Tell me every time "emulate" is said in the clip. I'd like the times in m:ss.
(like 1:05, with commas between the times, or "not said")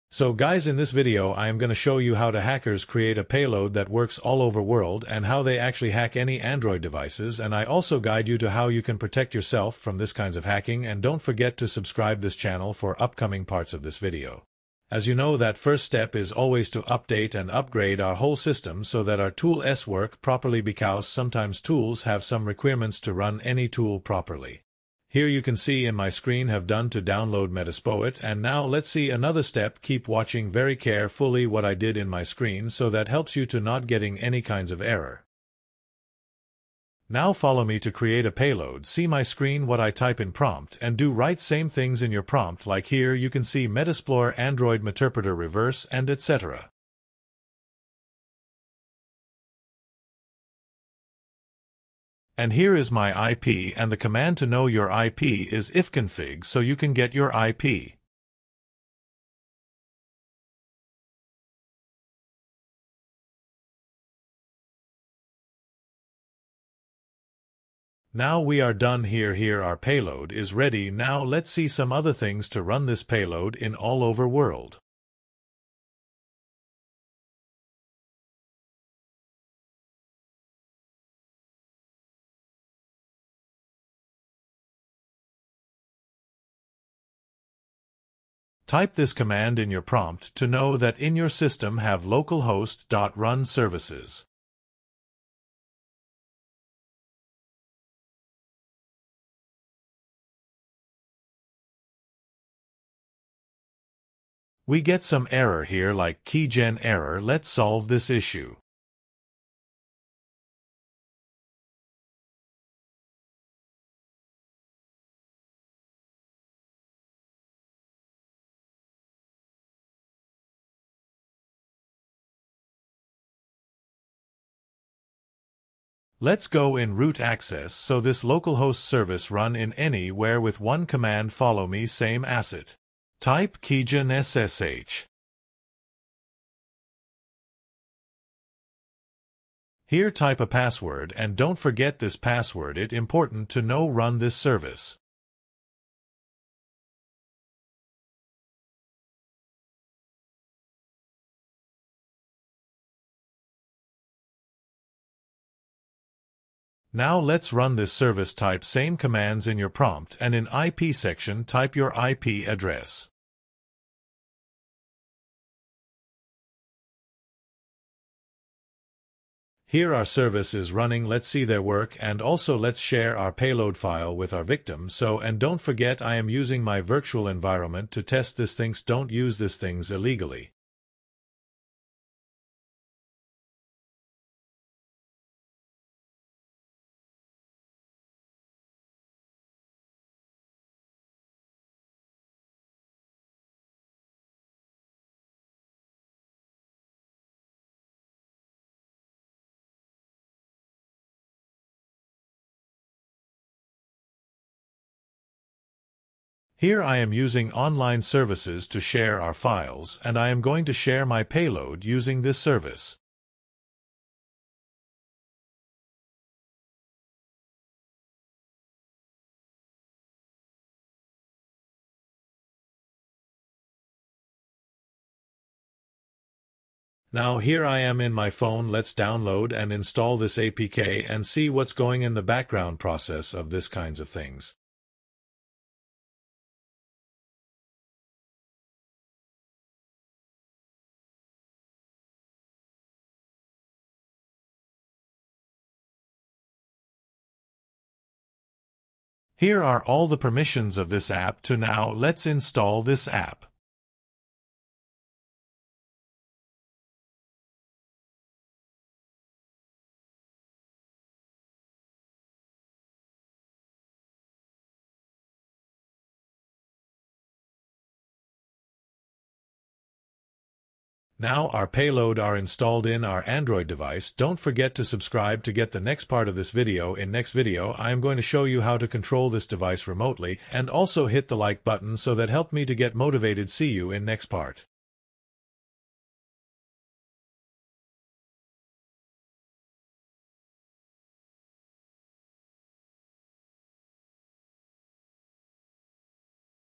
not said.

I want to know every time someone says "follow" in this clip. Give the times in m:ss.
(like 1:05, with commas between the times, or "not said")
0:37, 2:11.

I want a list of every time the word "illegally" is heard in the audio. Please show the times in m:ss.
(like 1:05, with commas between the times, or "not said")
2:59.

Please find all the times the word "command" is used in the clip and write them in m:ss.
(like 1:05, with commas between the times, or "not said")
0:54, 1:29, 2:10, 2:38.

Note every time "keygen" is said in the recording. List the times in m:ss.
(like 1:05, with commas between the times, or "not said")
1:46, 2:13.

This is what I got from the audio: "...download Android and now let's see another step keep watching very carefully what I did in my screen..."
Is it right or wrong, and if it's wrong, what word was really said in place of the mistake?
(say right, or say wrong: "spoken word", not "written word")
wrong: "Metaspoet", not "Android".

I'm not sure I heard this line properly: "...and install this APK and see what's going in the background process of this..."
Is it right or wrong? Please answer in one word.
right.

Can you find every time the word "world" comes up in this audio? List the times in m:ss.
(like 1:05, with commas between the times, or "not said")
0:04, 1:14.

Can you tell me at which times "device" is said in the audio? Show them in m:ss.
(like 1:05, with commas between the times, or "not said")
0:06, 4:33, 4:39.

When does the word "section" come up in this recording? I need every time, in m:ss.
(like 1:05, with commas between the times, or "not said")
2:40.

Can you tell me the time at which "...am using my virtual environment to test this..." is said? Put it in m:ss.
2:56.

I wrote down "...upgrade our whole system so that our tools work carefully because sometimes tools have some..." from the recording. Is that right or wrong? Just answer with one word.
wrong.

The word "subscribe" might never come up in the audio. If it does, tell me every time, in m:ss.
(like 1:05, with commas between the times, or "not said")
0:11, 4:34.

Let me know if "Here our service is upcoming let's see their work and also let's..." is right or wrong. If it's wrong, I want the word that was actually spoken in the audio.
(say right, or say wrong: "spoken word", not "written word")
wrong: "running", not "upcoming".